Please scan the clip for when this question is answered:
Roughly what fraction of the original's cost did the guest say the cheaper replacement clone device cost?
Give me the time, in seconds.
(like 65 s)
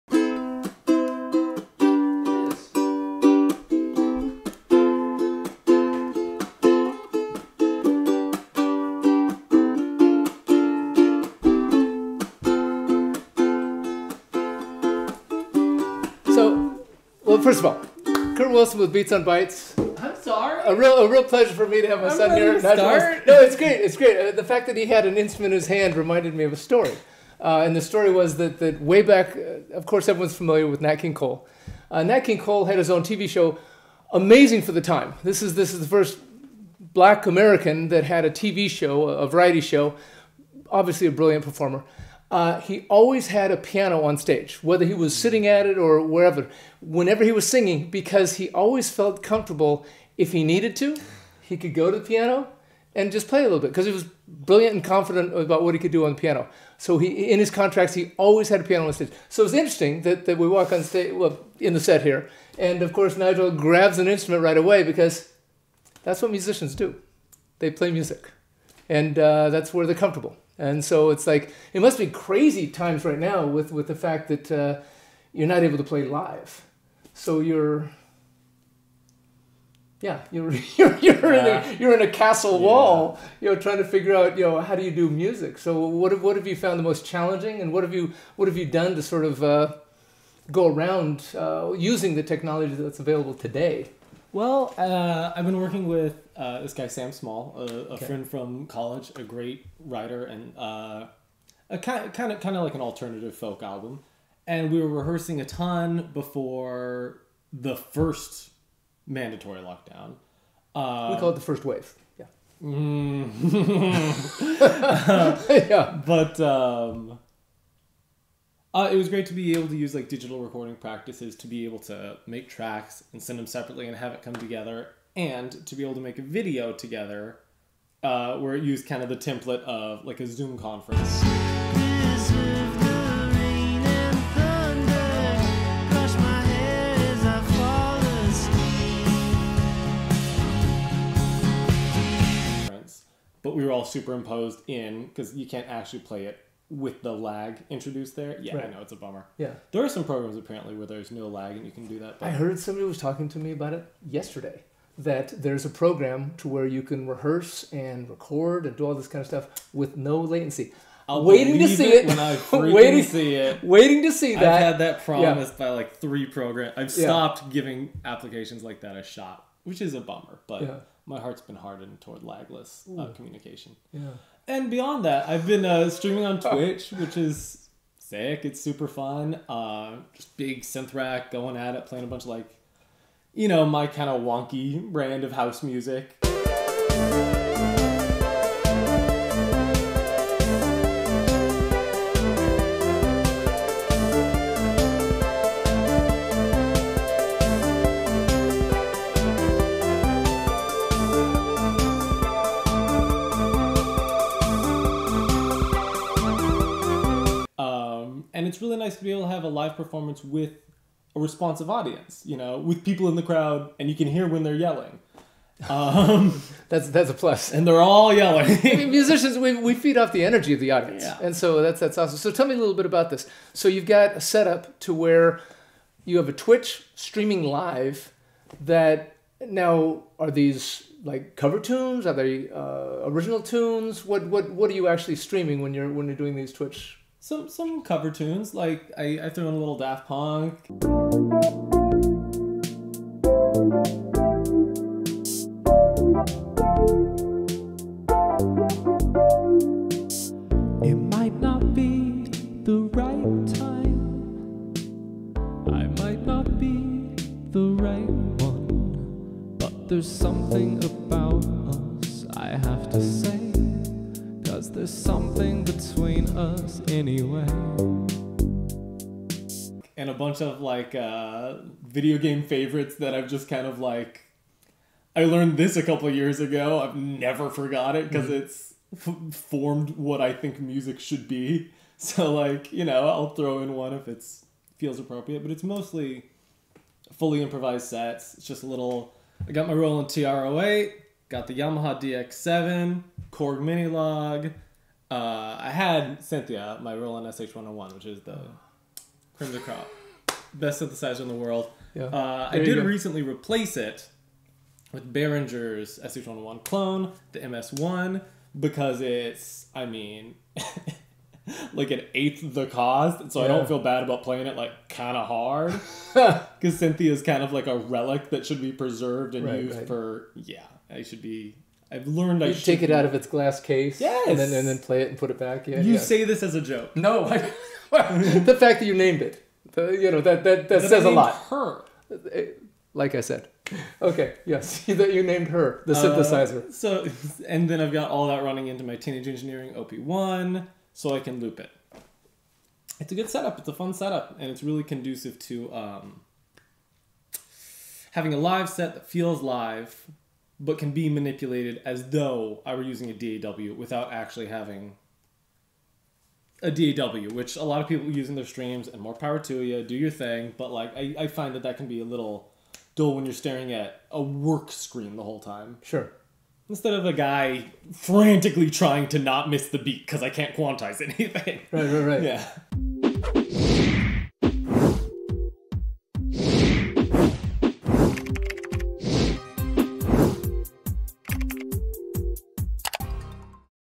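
311 s.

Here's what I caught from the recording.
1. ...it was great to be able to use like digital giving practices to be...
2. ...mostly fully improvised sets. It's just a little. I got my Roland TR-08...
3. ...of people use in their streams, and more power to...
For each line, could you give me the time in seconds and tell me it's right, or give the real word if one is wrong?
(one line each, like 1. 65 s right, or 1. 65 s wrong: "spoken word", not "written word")
1. 118 s wrong: "recording", not "giving"
2. 285 s right
3. 357 s right.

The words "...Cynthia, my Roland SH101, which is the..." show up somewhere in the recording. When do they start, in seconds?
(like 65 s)
296 s.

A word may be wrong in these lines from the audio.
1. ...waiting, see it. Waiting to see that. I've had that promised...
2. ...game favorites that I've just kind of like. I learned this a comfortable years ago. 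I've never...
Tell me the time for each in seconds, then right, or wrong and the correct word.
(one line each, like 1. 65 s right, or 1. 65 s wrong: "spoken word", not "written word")
1. 162 s right
2. 272 s wrong: "couple", not "comfortable".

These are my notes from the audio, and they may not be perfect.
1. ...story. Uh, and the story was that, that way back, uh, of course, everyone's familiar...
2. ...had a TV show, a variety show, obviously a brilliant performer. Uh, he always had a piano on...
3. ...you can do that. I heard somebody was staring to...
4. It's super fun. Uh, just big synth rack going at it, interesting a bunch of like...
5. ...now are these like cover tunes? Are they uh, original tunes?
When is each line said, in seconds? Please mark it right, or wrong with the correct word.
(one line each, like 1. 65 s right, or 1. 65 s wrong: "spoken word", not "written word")
1. 26 s right
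2. 38 s right
3. 151 s wrong: "talking", not "staring"
4. 178 s wrong: "playing", not "interesting"
5. 229 s right.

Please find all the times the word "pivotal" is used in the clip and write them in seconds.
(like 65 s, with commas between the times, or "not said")
not said.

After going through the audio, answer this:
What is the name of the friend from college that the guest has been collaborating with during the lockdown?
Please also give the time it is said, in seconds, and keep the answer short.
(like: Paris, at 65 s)
Sam Small, at 96 s.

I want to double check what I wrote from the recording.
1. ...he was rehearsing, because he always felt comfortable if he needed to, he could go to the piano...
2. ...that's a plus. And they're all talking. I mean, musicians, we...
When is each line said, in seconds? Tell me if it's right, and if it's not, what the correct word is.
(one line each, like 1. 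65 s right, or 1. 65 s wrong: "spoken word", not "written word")
1. 47 s wrong: "singing", not "rehearsing"
2. 216 s wrong: "yelling", not "talking".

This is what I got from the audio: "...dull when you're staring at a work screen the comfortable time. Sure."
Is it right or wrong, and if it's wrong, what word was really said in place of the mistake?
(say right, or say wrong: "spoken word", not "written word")
wrong: "whole", not "comfortable".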